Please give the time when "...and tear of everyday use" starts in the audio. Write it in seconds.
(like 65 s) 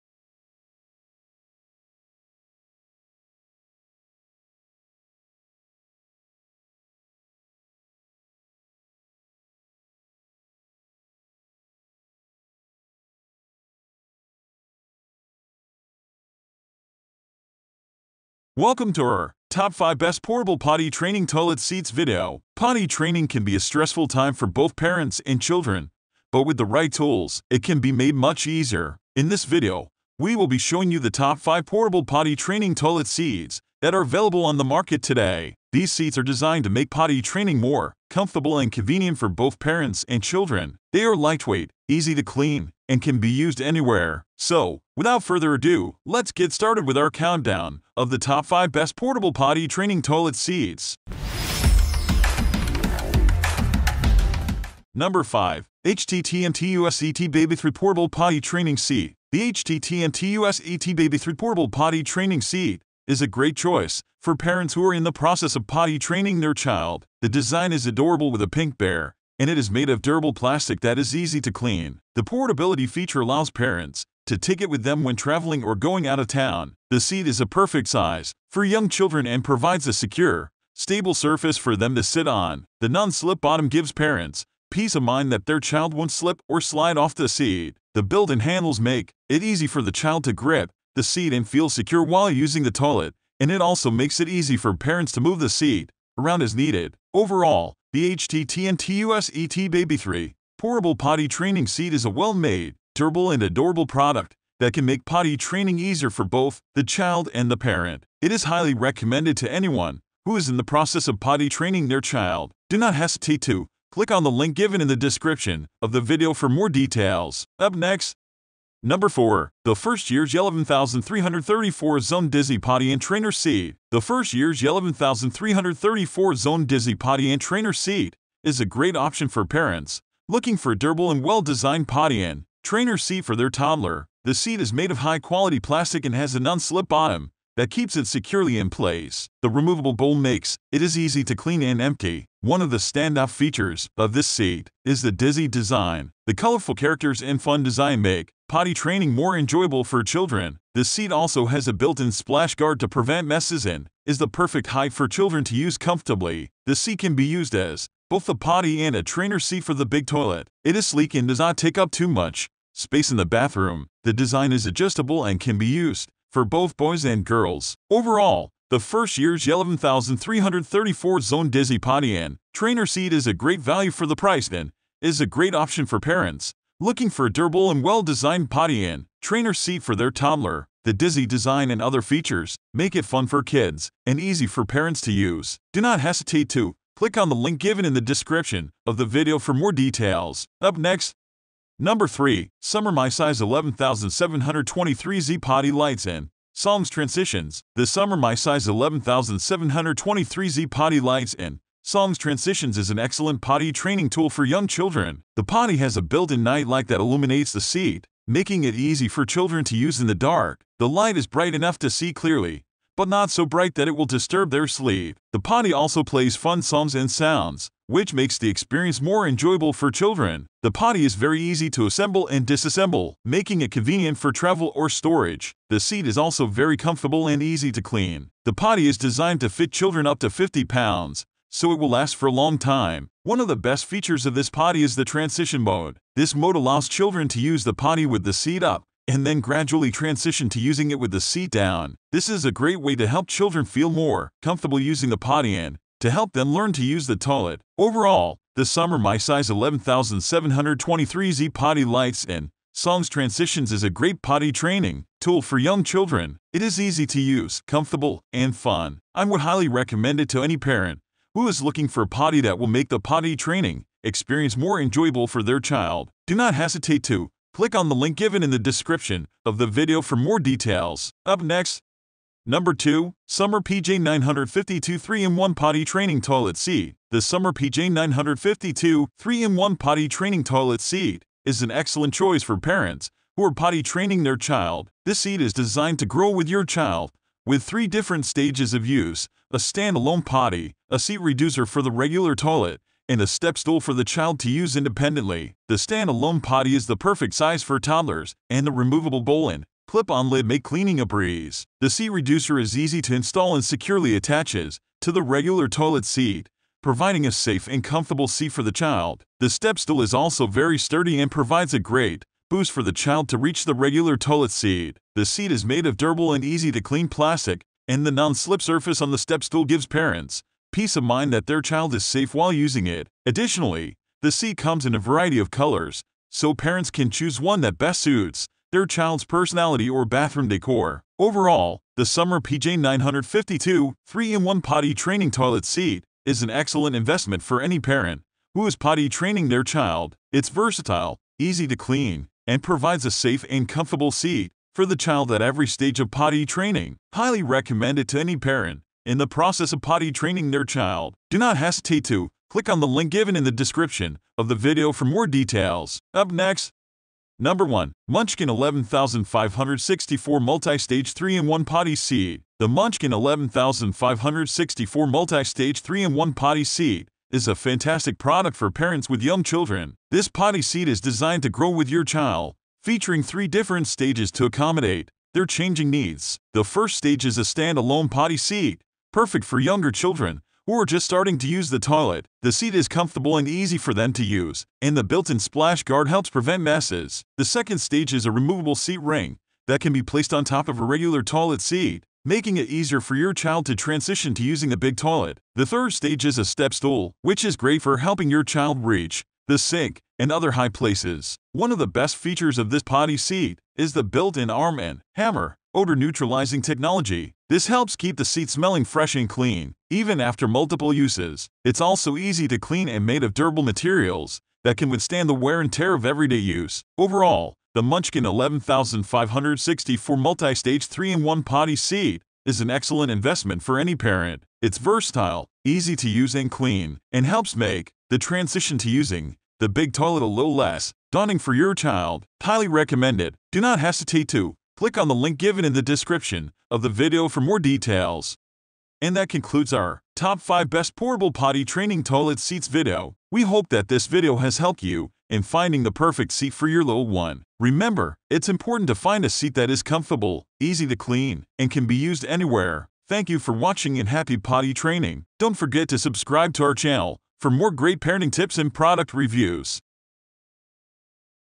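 415 s.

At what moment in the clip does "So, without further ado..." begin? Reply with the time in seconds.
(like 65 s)
44 s.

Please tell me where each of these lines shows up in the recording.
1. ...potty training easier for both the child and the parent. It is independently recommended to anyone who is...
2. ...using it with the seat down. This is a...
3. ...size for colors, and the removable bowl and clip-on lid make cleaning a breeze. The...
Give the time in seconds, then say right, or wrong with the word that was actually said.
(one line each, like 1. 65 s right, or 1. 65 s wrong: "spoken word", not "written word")
1. 105 s wrong: "highly", not "independently"
2. 240 s right
3. 297 s wrong: "toddlers", not "colors".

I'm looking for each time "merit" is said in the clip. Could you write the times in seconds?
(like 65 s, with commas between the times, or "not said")
not said.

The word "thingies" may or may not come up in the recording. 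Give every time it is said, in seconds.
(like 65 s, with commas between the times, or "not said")
not said.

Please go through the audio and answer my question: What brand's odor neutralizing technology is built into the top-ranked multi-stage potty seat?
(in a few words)
Arm and Hammer.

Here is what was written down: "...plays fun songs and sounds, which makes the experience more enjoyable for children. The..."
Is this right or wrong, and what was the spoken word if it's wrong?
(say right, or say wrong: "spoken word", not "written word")
right.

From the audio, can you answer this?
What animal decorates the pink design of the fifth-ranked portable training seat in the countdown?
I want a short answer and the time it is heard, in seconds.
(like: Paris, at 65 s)
Bear, at 68 s.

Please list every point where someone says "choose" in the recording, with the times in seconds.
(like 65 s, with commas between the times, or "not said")
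327 s.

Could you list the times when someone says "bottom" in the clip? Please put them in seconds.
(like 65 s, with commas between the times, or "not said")
83 s, 136 s.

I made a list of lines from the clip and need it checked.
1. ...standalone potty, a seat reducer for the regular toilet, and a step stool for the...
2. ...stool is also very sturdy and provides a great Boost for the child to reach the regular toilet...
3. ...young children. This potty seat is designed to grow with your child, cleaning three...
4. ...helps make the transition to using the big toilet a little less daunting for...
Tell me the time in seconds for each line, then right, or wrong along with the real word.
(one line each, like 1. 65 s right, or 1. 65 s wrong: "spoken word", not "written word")
1. 289 s right
2. 309 s right
3. 369 s wrong: "featuring", not "cleaning"
4. 427 s right.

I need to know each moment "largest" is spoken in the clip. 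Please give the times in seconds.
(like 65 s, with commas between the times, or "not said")
not said.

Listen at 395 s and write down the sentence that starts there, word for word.
The third stage is a step stool, which is great for helping your child reach the sink, and other high places.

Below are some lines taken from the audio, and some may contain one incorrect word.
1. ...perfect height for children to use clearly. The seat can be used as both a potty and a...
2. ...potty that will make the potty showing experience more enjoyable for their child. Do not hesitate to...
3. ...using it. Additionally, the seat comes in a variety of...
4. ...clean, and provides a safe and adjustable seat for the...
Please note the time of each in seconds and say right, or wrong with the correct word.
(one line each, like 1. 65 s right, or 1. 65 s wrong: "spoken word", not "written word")
1. 154 s wrong: "comfortably", not "clearly"
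2. 262 s wrong: "training", not "showing"
3. 322 s right
4. 341 s wrong: "comfortable", not "adjustable".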